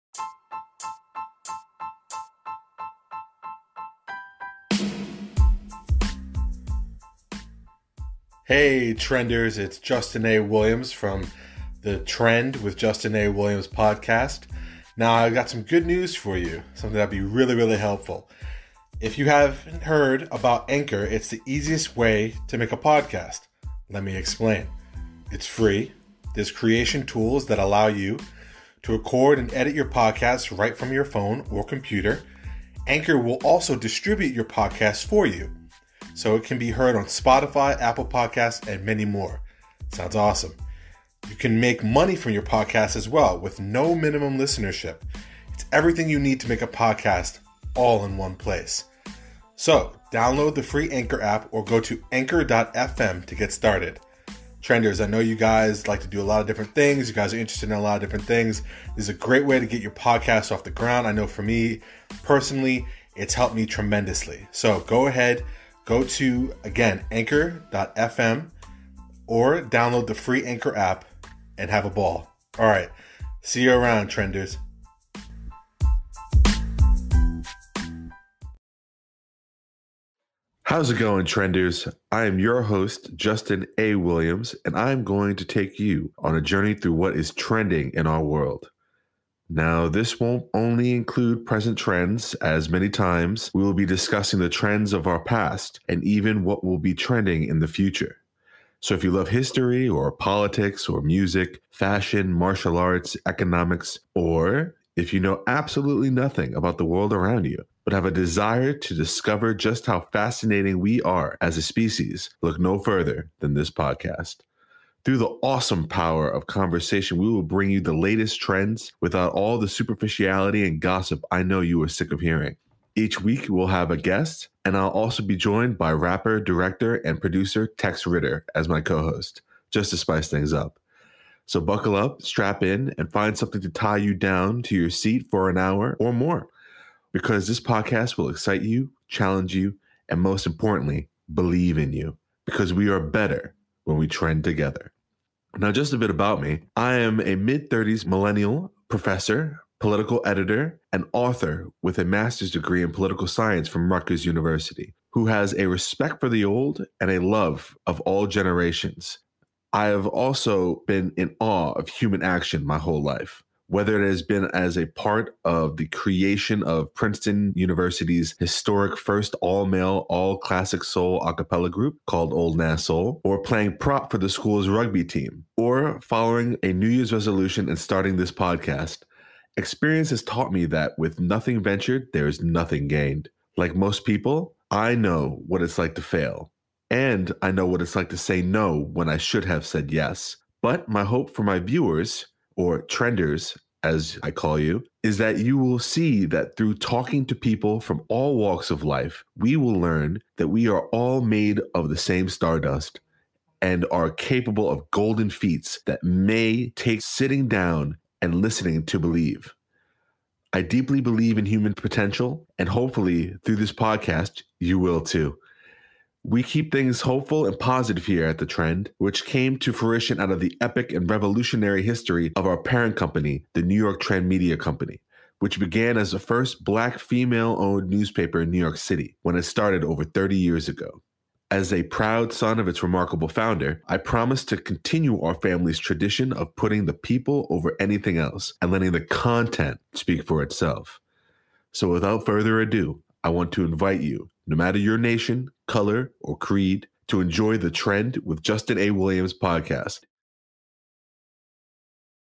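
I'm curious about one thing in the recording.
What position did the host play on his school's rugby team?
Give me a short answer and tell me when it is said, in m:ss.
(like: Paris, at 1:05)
Prop, at 2:53.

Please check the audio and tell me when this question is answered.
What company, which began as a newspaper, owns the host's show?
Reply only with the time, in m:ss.
3:43.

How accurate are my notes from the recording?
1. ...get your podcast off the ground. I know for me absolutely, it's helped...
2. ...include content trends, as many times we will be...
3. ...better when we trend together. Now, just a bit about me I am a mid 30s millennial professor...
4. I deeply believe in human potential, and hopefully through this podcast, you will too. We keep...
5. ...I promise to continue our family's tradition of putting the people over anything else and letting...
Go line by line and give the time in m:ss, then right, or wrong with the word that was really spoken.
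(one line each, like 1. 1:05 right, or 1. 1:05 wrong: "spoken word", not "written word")
1. 0:59 wrong: "personally", not "absolutely"
2. 1:30 wrong: "present", not "content"
3. 2:22 right
4. 3:30 right
5. 3:53 right.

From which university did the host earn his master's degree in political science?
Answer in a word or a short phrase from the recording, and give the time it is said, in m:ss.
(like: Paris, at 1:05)
Rutgers University, at 2:33.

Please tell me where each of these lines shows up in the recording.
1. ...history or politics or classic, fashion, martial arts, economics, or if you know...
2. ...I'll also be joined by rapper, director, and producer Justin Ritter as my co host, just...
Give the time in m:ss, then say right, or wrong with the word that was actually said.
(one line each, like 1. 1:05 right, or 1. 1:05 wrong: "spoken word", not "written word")
1. 1:39 wrong: "music", not "classic"
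2. 2:04 wrong: "Tex", not "Justin".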